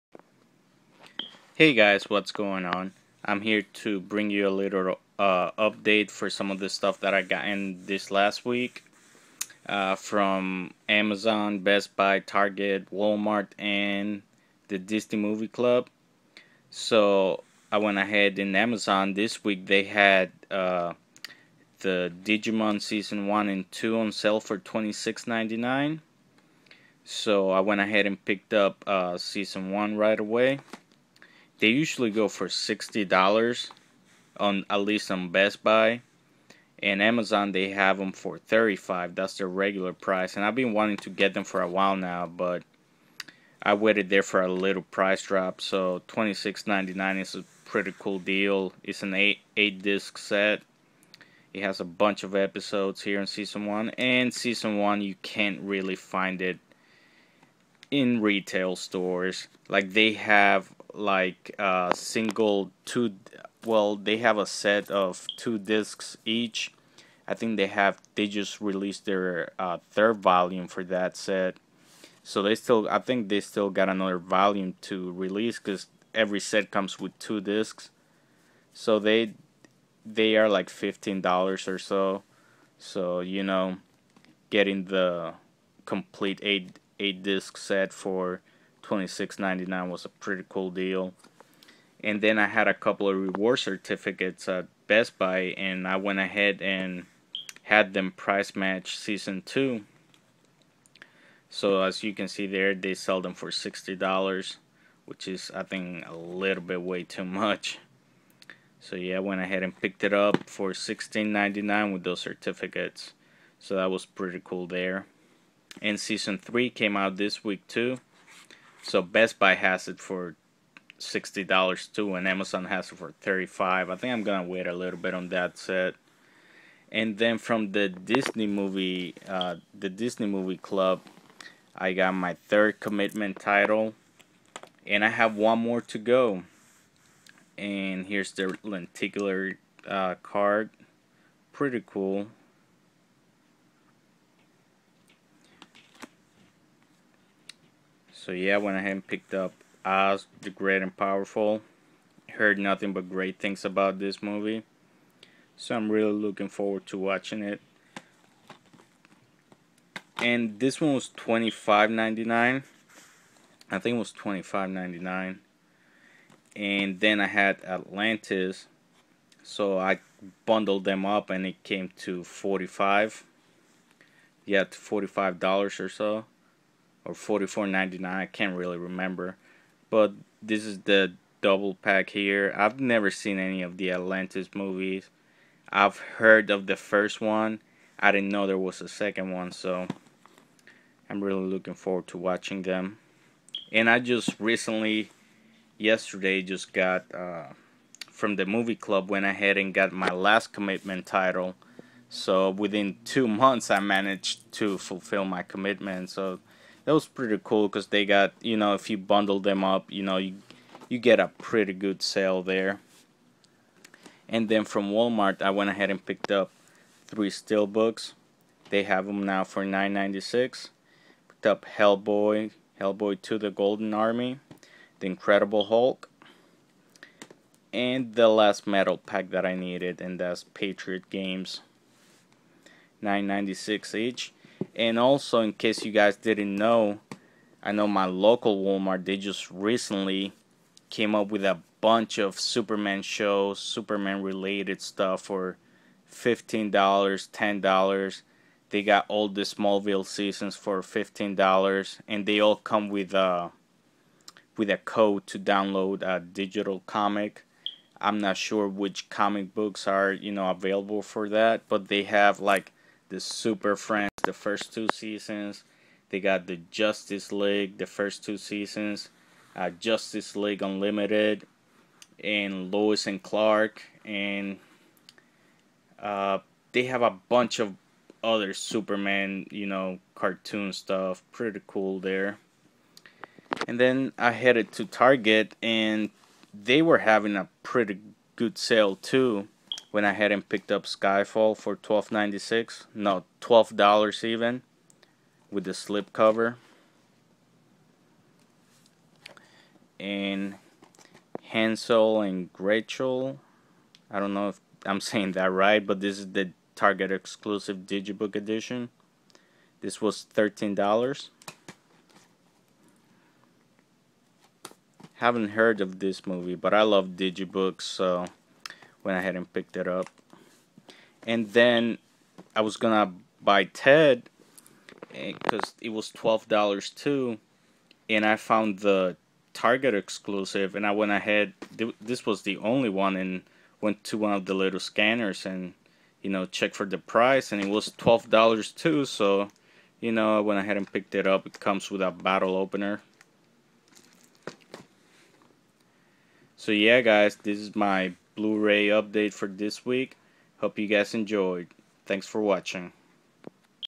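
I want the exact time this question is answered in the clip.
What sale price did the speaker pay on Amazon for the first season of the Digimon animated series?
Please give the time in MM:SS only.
00:24.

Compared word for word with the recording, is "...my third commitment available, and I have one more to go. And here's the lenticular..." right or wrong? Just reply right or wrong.
wrong.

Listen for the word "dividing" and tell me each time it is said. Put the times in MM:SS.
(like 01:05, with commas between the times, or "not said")
not said.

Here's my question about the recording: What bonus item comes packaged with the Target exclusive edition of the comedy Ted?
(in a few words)
A bottle opener.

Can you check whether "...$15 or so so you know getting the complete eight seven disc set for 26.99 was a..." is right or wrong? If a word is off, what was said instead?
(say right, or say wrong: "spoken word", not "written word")
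wrong: "eight", not "seven".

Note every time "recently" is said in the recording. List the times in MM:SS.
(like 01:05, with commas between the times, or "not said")
03:14, 03:59.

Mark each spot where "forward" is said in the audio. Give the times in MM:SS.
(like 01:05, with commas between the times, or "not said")
02:36, 03:11.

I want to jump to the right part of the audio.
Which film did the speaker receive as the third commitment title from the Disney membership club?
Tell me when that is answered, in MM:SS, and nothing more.
02:29.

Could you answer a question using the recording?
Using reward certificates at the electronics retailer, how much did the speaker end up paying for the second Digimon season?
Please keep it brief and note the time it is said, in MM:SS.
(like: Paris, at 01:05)
$16.99, at 01:50.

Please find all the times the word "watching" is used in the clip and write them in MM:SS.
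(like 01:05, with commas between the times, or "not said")
02:36, 03:12, 05:52.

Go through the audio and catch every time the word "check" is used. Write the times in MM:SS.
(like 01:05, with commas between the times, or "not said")
05:36.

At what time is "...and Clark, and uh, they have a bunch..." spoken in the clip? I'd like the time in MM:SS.
04:33.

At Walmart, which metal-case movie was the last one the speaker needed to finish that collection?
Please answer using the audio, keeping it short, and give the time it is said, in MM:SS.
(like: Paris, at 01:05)
Patriot Games, at 03:50.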